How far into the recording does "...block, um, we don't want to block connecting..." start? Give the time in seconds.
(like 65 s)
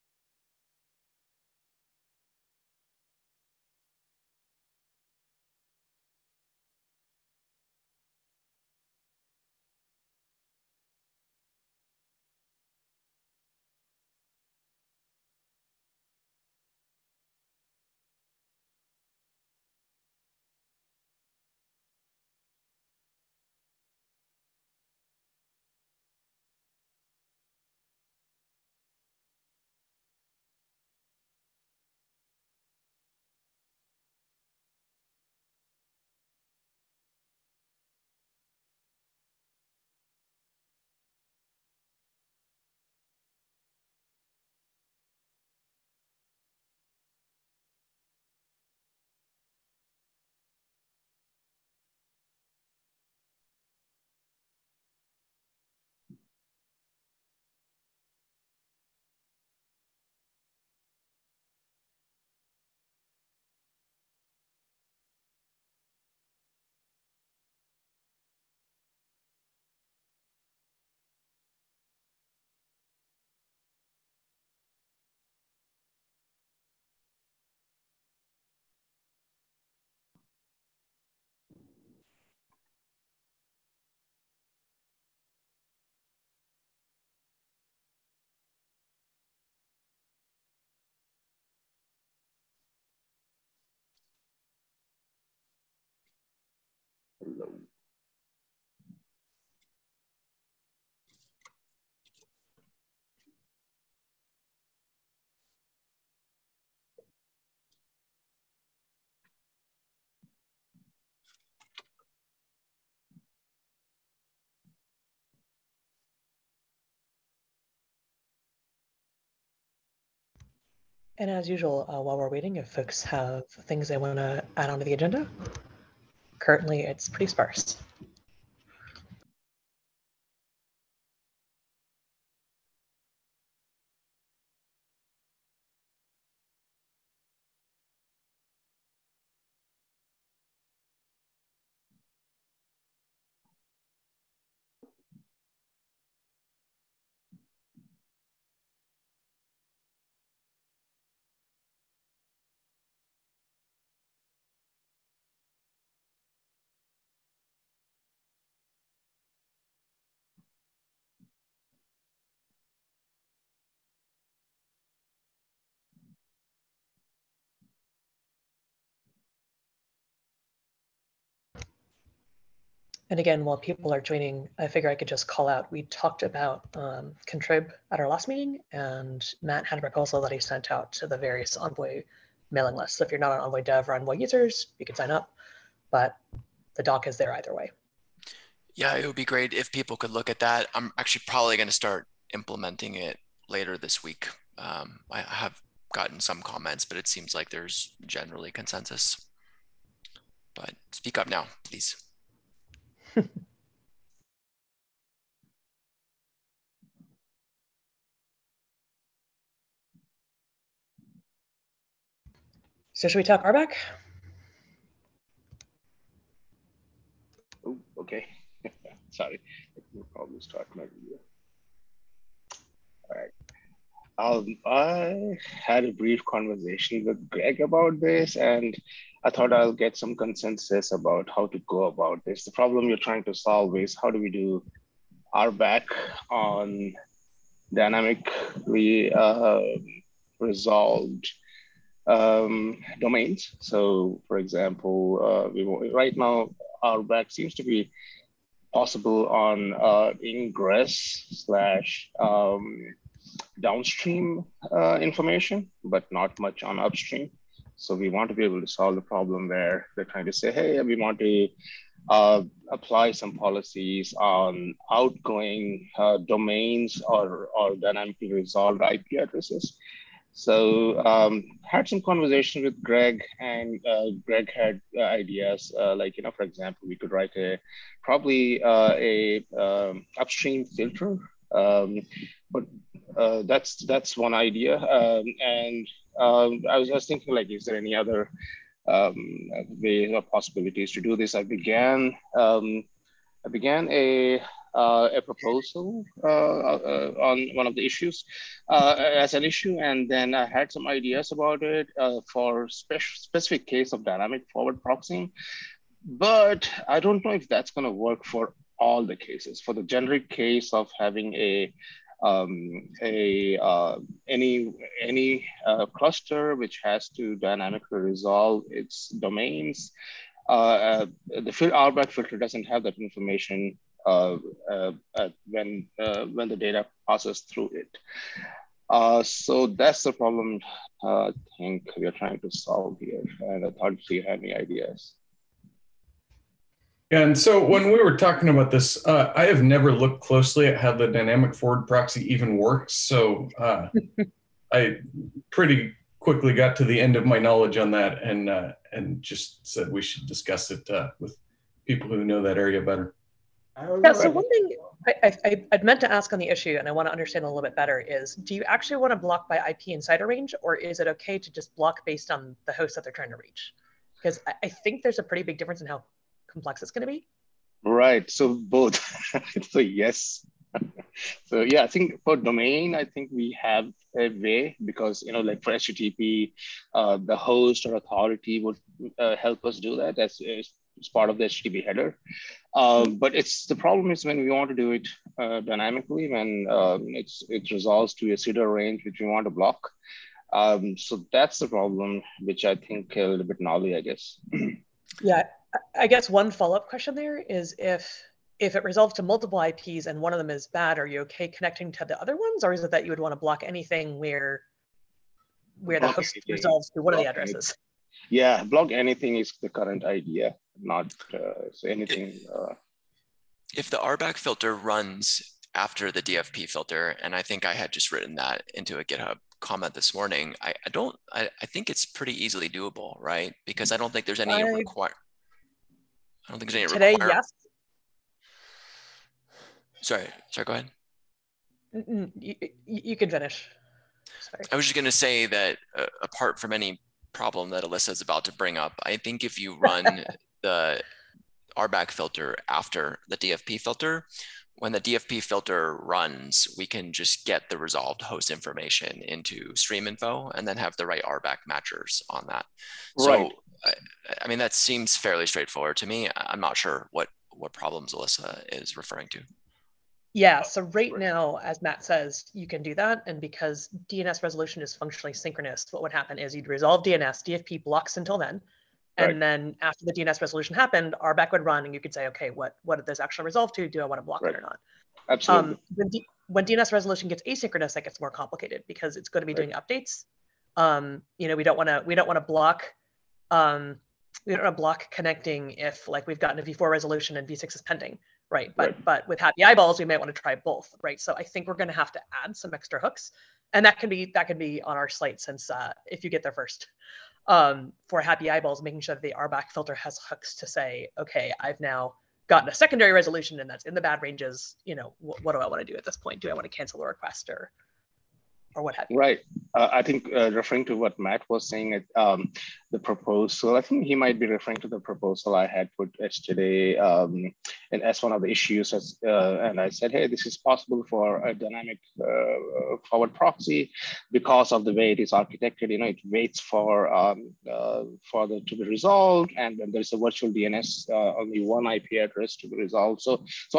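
482 s.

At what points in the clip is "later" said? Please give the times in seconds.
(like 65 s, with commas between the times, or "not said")
193 s.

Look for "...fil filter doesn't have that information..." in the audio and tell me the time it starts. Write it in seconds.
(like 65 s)
321 s.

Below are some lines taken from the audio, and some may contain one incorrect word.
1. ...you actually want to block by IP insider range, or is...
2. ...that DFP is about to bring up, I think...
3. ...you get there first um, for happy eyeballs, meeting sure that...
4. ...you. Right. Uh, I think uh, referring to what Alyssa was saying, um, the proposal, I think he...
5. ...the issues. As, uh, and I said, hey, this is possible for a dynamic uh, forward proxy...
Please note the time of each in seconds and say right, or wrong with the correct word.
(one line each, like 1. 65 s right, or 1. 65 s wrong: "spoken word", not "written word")
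1. 358 s right
2. 437 s wrong: "Alyssa", not "DFP"
3. 496 s wrong: "making", not "meeting"
4. 509 s wrong: "Matt", not "Alyssa"
5. 518 s right.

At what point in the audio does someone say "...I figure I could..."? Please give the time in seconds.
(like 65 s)
174 s.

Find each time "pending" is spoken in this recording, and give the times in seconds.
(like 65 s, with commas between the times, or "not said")
487 s.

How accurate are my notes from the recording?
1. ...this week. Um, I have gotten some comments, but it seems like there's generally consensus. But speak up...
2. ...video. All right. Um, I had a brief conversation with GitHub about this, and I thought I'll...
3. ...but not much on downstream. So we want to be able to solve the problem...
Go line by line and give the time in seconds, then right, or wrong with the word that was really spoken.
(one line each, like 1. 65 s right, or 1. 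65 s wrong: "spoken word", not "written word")
1. 193 s right
2. 220 s wrong: "Greg", not "GitHub"
3. 255 s wrong: "upstream", not "downstream".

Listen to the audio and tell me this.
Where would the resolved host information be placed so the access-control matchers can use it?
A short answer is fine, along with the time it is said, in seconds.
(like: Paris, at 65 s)
stream info, at 449 s.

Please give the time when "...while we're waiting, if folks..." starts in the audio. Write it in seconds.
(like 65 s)
122 s.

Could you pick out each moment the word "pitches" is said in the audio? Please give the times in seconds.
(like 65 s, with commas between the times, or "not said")
not said.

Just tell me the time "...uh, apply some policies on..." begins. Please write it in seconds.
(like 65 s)
262 s.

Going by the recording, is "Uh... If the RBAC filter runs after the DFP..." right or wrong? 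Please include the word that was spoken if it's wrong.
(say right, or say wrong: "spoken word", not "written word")
right.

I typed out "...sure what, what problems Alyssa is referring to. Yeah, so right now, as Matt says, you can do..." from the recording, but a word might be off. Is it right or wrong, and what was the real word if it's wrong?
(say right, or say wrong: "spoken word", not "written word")
right.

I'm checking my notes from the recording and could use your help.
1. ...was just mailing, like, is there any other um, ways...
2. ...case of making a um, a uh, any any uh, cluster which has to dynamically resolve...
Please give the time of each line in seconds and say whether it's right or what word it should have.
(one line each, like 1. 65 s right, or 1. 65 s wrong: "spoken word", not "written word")
1. 286 s wrong: "thinking", not "mailing"
2. 310 s wrong: "having", not "making".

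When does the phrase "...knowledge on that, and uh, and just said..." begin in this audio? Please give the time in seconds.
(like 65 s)
347 s.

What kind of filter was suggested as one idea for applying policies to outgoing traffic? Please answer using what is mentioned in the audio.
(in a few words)
upstream filter.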